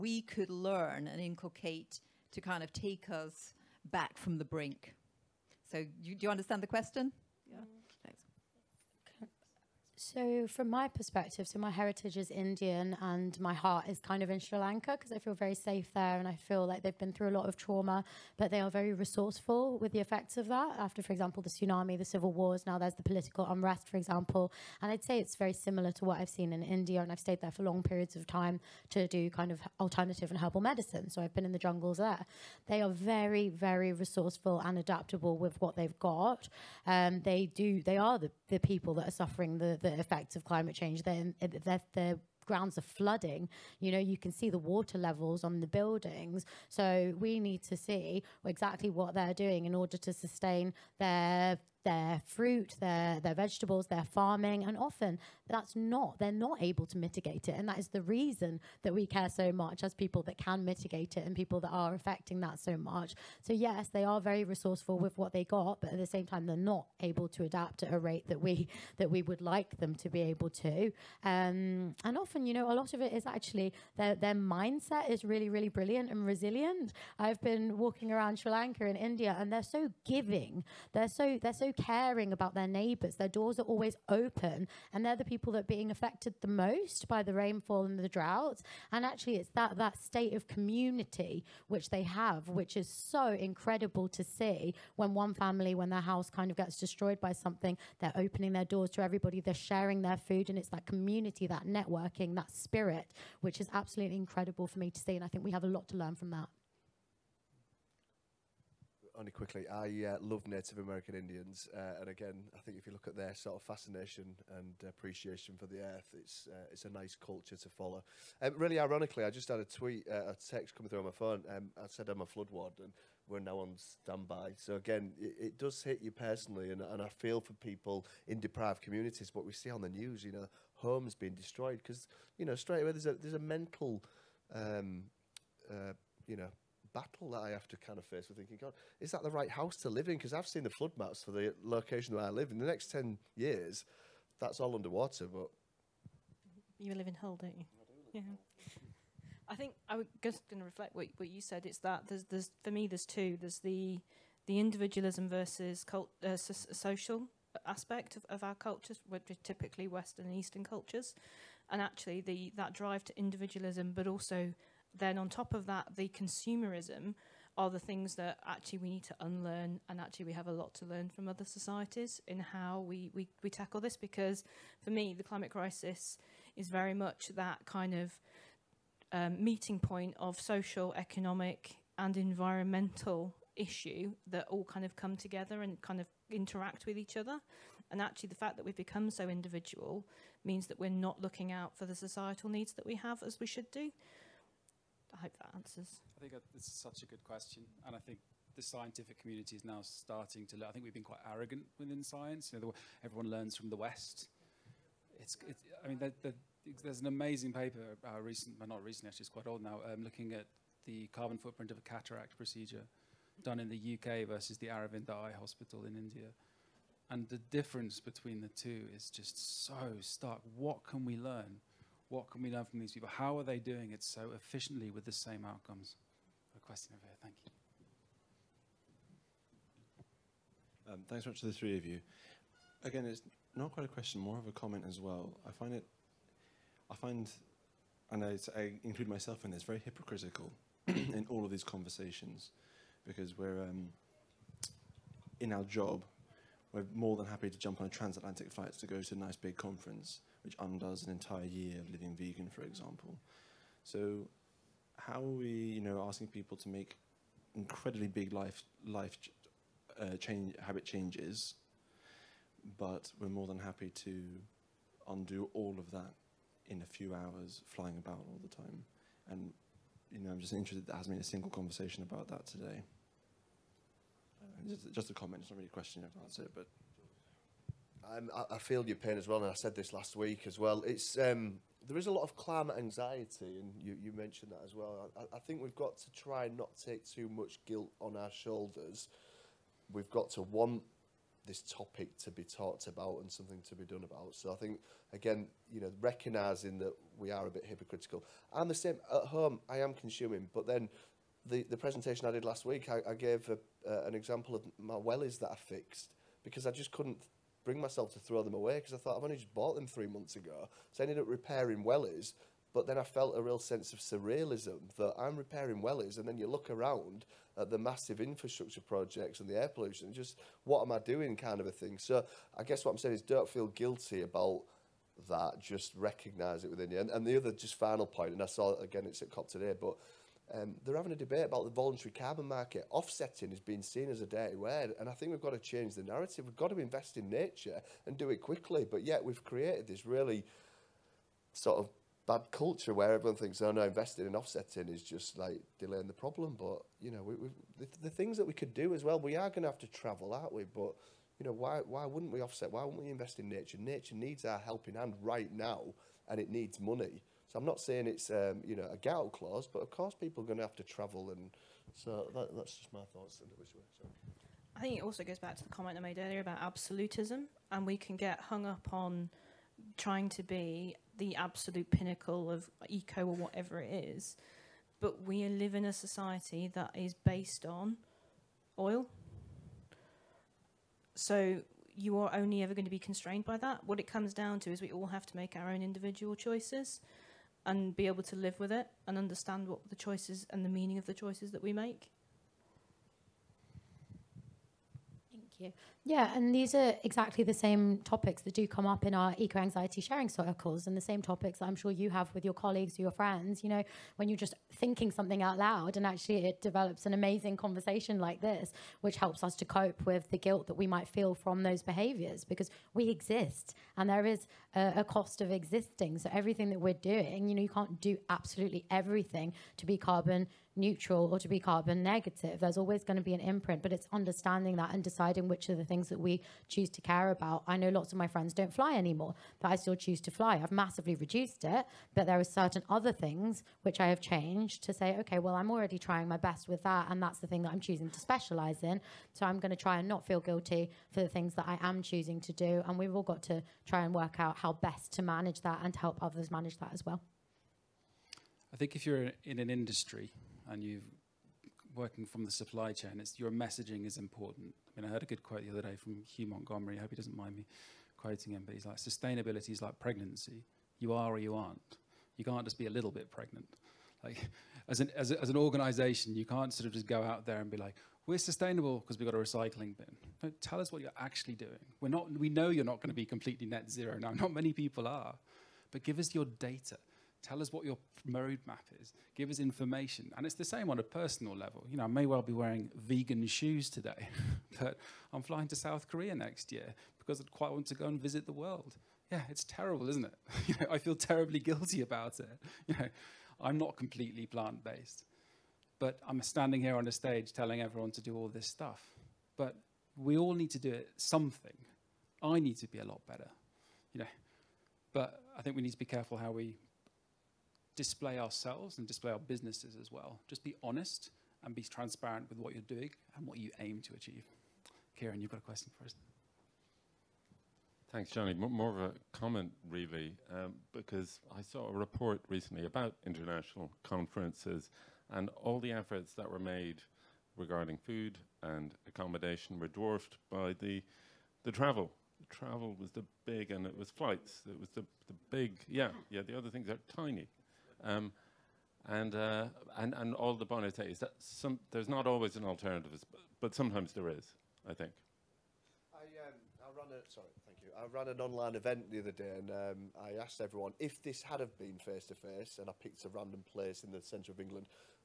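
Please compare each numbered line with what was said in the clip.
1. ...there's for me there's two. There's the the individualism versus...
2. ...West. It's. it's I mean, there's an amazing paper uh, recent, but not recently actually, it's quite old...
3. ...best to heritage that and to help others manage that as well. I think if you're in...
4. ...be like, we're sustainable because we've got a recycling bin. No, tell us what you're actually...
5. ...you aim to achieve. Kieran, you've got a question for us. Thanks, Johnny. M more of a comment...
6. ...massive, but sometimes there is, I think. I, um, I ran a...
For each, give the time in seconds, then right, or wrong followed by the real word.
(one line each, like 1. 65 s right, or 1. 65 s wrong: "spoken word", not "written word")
1. 152 s right
2. 203 s right
3. 444 s wrong: "manage", not "heritage"
4. 467 s right
5. 513 s right
6. 542 s wrong: "alternative", not "massive".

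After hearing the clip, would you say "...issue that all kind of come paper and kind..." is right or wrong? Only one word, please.
wrong.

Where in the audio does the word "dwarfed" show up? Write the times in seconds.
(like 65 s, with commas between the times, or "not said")
529 s.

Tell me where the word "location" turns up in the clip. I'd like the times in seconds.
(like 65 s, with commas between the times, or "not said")
141 s.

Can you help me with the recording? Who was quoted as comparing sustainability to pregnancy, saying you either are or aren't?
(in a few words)
Hugh Montgomery.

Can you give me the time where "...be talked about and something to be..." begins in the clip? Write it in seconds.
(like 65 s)
292 s.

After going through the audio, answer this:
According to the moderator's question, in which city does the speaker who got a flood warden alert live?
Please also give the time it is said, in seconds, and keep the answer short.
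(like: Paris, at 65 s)
Hull, at 147 s.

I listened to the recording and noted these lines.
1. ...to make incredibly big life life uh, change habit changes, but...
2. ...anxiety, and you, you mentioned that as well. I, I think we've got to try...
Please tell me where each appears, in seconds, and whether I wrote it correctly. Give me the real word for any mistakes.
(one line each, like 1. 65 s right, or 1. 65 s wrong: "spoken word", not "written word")
1. 256 s right
2. 282 s right.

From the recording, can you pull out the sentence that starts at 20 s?
After, for example, the tsunami, the civil wars, now there's the political unrest, for example.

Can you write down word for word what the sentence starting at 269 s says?
And you know, I'm just interested.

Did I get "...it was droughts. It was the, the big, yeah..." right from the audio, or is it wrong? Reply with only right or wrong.
wrong.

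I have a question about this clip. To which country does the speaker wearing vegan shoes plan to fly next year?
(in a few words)
South Korea.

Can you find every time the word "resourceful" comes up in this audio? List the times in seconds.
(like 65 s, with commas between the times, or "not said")
18 s, 33 s, 64 s.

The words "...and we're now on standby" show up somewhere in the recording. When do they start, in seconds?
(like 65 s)
122 s.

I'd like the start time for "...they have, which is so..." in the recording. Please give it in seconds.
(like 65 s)
91 s.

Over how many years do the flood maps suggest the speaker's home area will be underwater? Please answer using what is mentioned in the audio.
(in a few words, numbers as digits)
10 years.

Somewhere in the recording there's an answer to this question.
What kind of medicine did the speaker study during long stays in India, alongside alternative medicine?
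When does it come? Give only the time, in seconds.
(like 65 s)
30 s.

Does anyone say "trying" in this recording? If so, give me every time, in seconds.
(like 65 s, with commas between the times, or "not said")
369 s, 435 s.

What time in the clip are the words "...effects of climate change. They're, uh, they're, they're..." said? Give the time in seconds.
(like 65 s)
40 s.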